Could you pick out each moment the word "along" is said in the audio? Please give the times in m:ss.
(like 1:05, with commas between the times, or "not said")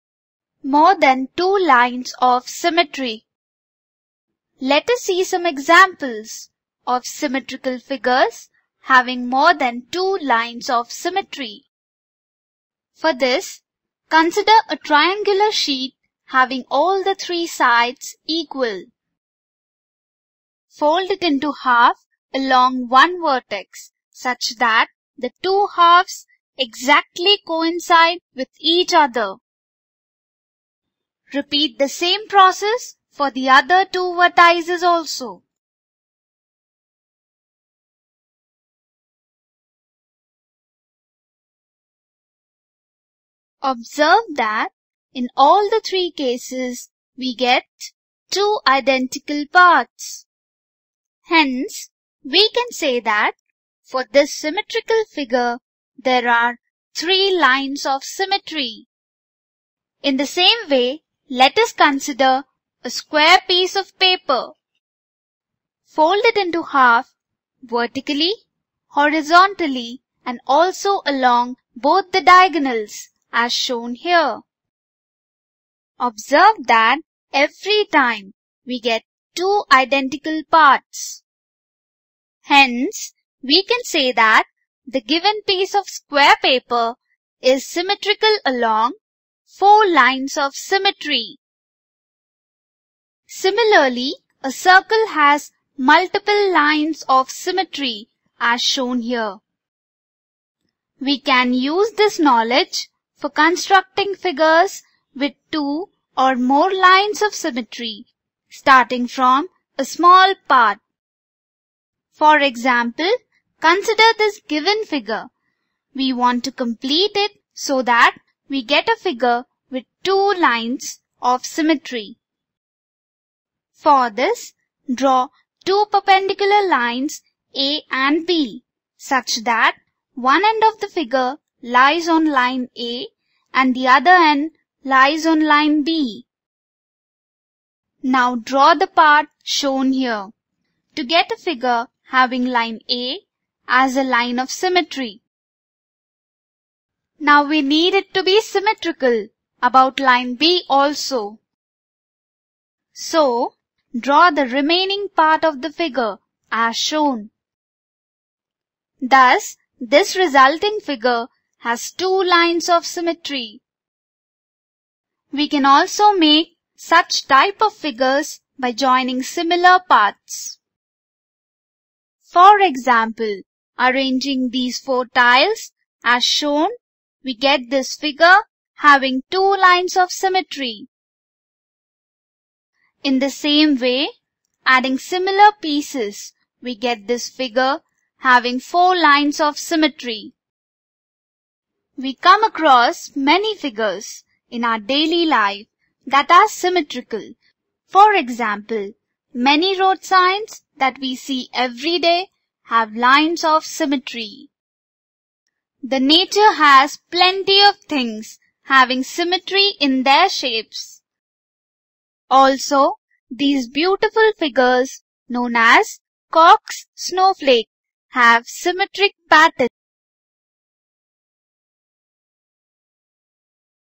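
0:22, 1:11, 1:28.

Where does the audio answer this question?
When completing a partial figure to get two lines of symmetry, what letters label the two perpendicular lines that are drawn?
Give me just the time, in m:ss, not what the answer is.
2:07.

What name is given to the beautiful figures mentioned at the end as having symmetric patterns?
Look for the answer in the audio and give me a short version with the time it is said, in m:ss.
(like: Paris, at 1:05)
Koch snowflake, at 3:36.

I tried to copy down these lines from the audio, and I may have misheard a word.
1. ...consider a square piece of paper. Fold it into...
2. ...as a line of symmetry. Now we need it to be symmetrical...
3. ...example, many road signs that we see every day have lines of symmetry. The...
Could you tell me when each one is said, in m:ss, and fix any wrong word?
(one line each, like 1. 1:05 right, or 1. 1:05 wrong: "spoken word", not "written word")
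1. 1:01 right
2. 2:23 right
3. 3:18 right.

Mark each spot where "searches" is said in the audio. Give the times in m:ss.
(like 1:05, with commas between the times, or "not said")
not said.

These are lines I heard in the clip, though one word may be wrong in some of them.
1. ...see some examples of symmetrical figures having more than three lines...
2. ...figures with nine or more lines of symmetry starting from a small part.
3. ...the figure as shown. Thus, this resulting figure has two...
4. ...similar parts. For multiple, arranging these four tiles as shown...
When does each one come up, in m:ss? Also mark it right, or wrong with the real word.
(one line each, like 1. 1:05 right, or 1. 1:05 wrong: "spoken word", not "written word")
1. 0:05 wrong: "two", not "three"
2. 1:44 wrong: "two", not "nine"
3. 2:35 right
4. 2:49 wrong: "example", not "multiple".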